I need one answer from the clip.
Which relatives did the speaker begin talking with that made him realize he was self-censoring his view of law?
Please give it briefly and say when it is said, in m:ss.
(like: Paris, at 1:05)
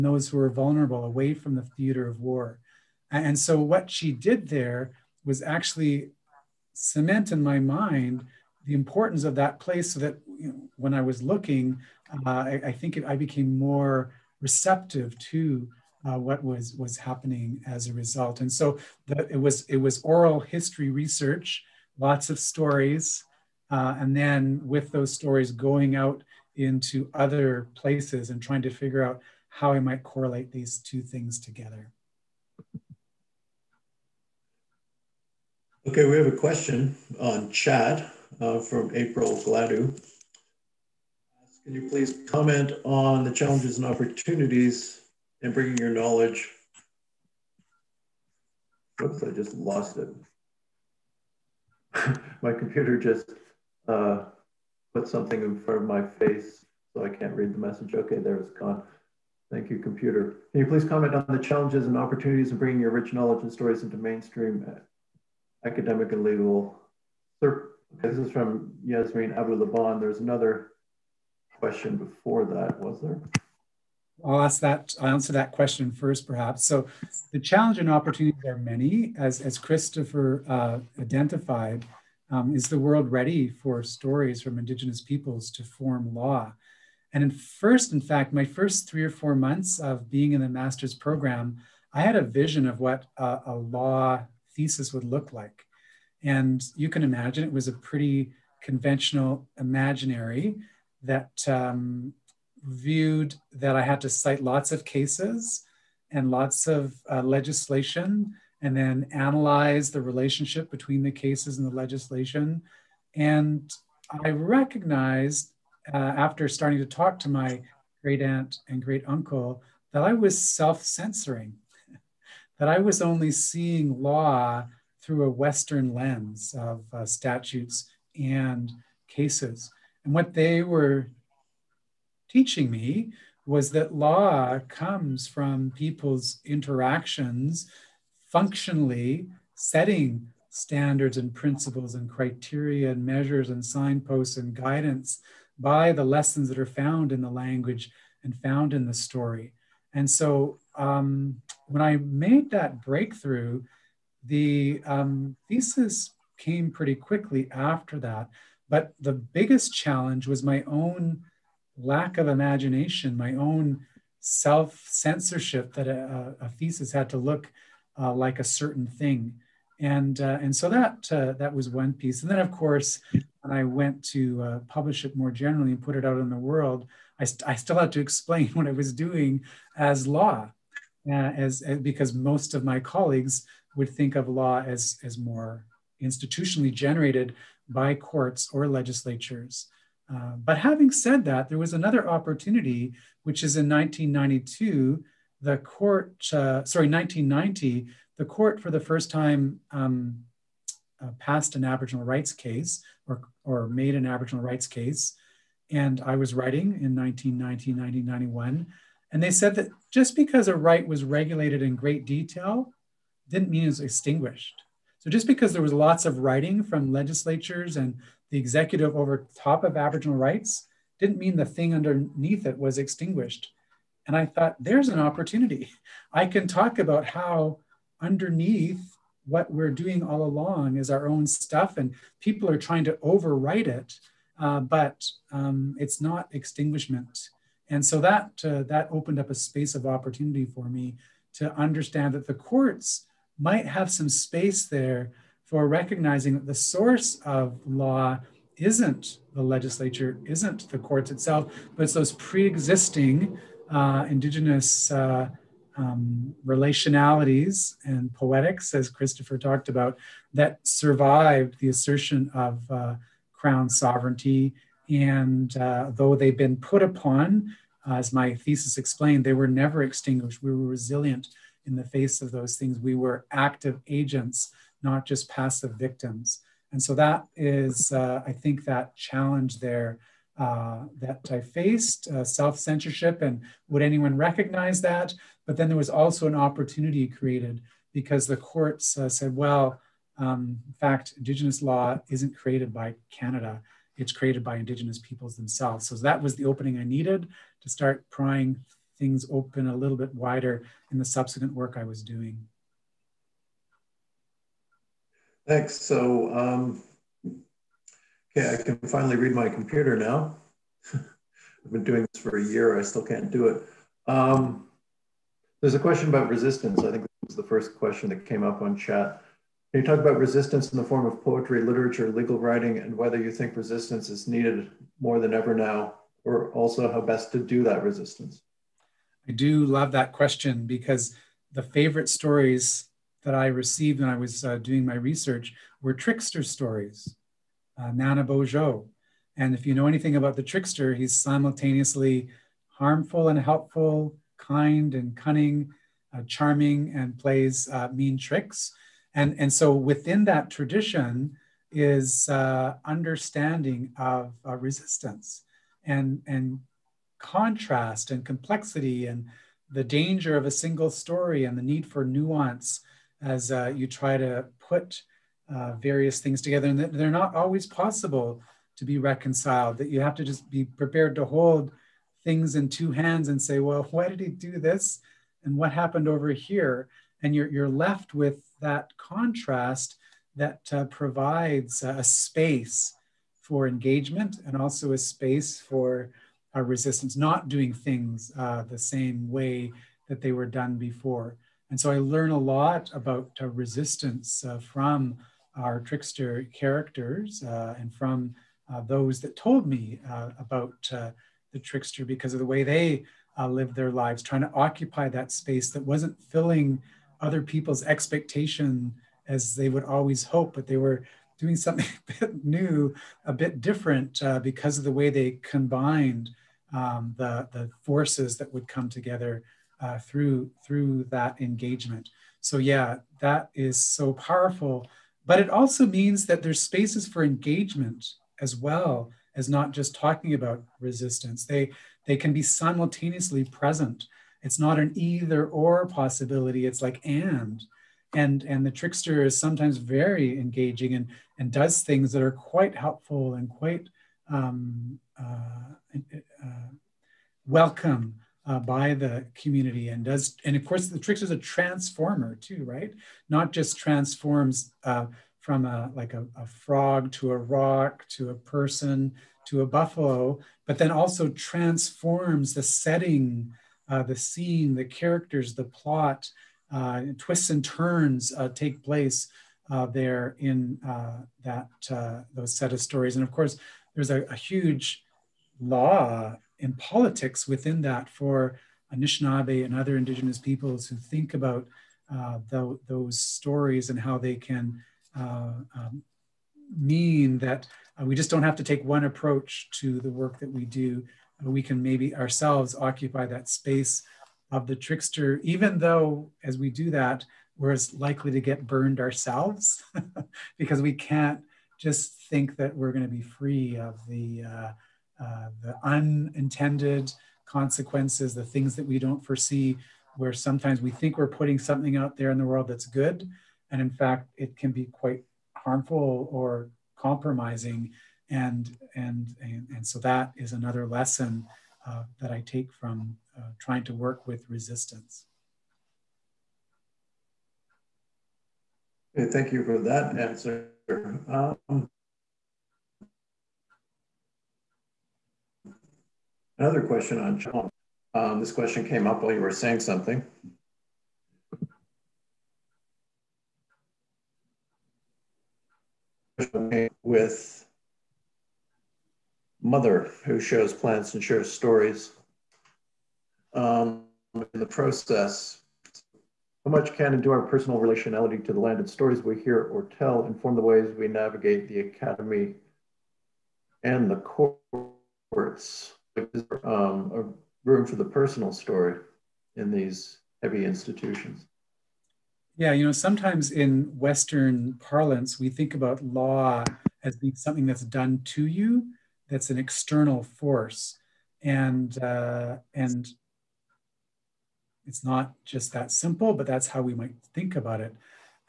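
great aunt and great uncle, at 1:58.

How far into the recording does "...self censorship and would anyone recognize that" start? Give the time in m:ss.
4:42.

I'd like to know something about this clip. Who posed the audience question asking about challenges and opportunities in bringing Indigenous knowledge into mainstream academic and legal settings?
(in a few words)
Yasmeen Abu-Laban.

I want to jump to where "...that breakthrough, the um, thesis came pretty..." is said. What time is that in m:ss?
2:32.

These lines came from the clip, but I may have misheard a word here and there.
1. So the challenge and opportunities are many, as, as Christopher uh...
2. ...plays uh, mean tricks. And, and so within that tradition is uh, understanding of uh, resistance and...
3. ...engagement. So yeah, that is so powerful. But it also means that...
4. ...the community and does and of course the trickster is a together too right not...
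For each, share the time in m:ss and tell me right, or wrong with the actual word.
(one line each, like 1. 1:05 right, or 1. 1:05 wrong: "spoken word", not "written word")
1. 1:16 right
2. 5:47 right
3. 7:01 right
4. 7:28 wrong: "transformer", not "together".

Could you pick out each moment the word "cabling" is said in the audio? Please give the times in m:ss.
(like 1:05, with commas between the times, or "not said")
not said.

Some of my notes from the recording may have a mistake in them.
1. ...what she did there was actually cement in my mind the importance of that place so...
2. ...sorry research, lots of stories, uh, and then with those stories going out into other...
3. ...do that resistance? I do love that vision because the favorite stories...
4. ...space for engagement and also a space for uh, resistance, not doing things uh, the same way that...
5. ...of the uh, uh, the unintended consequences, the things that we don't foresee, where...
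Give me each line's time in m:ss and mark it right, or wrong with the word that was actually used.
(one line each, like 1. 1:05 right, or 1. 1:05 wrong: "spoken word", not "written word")
1. 0:03 right
2. 0:20 wrong: "history", not "sorry"
3. 5:27 wrong: "question", not "vision"
4. 6:22 right
5. 8:23 right.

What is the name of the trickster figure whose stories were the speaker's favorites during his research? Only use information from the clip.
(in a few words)
Nana Bojo.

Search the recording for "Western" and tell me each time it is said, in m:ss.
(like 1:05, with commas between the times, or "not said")
2:05, 9:33.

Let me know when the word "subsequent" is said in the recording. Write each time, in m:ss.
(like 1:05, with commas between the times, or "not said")
5:01.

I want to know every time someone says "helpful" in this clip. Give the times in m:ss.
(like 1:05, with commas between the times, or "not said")
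5:43, 7:22.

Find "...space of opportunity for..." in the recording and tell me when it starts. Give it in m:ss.
3:59.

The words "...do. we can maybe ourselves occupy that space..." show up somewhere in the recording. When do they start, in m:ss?
8:10.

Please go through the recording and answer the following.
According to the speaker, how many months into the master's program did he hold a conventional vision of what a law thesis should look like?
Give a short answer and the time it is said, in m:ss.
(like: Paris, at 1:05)
3 or 4, at 1:28.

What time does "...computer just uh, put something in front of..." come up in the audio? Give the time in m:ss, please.
0:52.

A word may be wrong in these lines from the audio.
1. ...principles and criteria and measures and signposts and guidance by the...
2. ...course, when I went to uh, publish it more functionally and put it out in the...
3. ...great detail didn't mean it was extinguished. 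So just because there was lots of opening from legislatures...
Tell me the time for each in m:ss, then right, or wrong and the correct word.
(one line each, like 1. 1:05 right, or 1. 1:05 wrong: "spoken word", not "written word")
1. 2:21 right
2. 2:52 wrong: "generally", not "functionally"
3. 3:31 wrong: "writing", not "opening".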